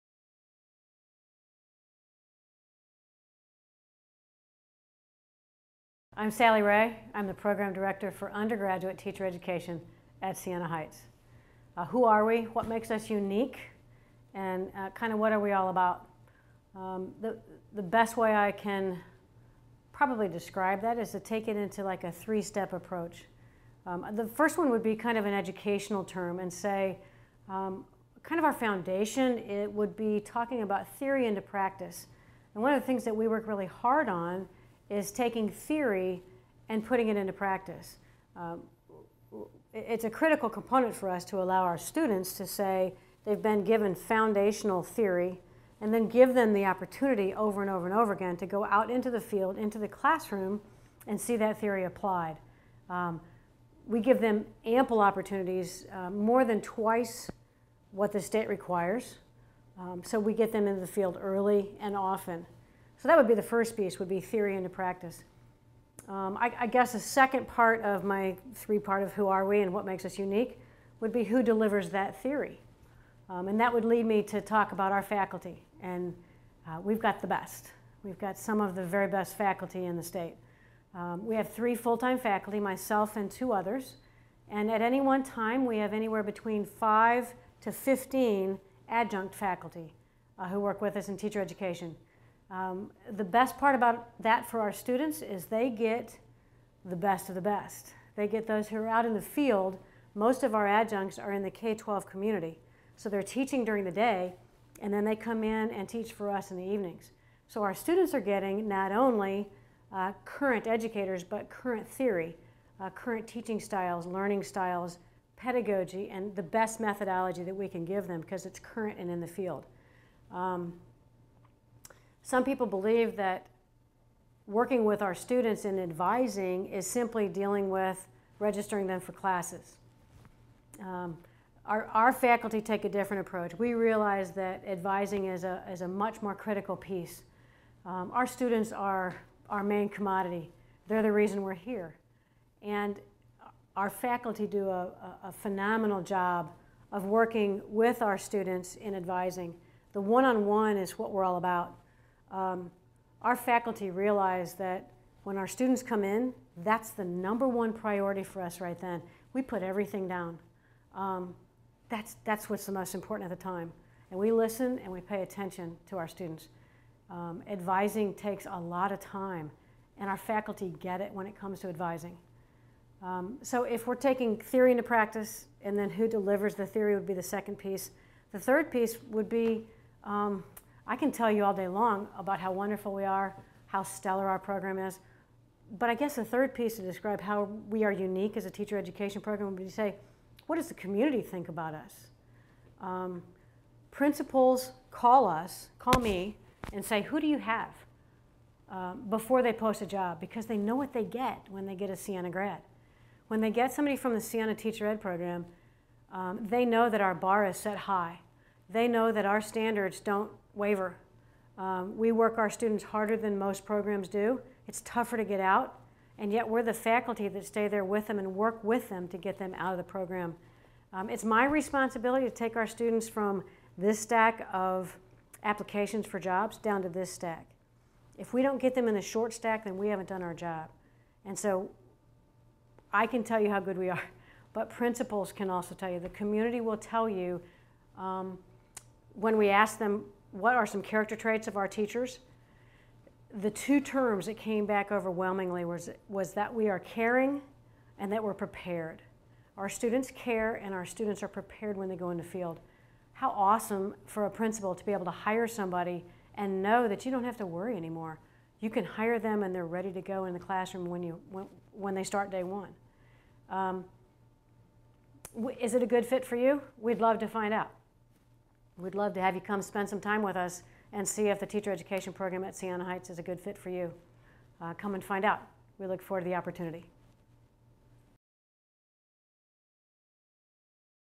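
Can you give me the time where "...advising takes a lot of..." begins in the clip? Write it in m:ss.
2:47.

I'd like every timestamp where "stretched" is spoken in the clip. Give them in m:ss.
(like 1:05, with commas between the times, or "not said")
not said.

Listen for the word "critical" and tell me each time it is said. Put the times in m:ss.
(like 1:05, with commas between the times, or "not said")
0:40, 2:16.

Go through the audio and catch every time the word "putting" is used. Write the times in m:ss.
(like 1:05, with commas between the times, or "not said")
0:36.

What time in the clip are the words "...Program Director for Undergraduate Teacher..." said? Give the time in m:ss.
0:07.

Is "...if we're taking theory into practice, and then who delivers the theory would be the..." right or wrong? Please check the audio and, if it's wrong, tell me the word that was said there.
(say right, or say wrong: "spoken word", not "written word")
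right.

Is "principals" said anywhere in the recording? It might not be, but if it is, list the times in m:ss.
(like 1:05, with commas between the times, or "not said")
3:13, 3:54, 4:14.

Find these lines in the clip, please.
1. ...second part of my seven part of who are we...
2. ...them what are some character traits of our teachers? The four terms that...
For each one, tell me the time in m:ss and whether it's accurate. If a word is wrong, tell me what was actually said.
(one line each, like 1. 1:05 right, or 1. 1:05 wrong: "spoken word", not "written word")
1. 1:06 wrong: "three", not "seven"
2. 3:59 wrong: "two", not "four".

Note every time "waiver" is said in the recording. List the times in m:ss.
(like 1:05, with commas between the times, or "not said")
3:30.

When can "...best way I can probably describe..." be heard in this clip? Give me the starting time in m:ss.
0:17.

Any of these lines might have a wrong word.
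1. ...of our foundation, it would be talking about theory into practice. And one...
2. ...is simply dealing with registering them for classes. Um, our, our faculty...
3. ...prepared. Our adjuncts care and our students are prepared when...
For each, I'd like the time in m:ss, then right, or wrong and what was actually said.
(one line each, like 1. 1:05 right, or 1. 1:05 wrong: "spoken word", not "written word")
1. 0:28 right
2. 2:06 right
3. 4:08 wrong: "students", not "adjuncts".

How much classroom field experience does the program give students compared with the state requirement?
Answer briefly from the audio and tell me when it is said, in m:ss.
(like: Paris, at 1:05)
More than twice, at 0:56.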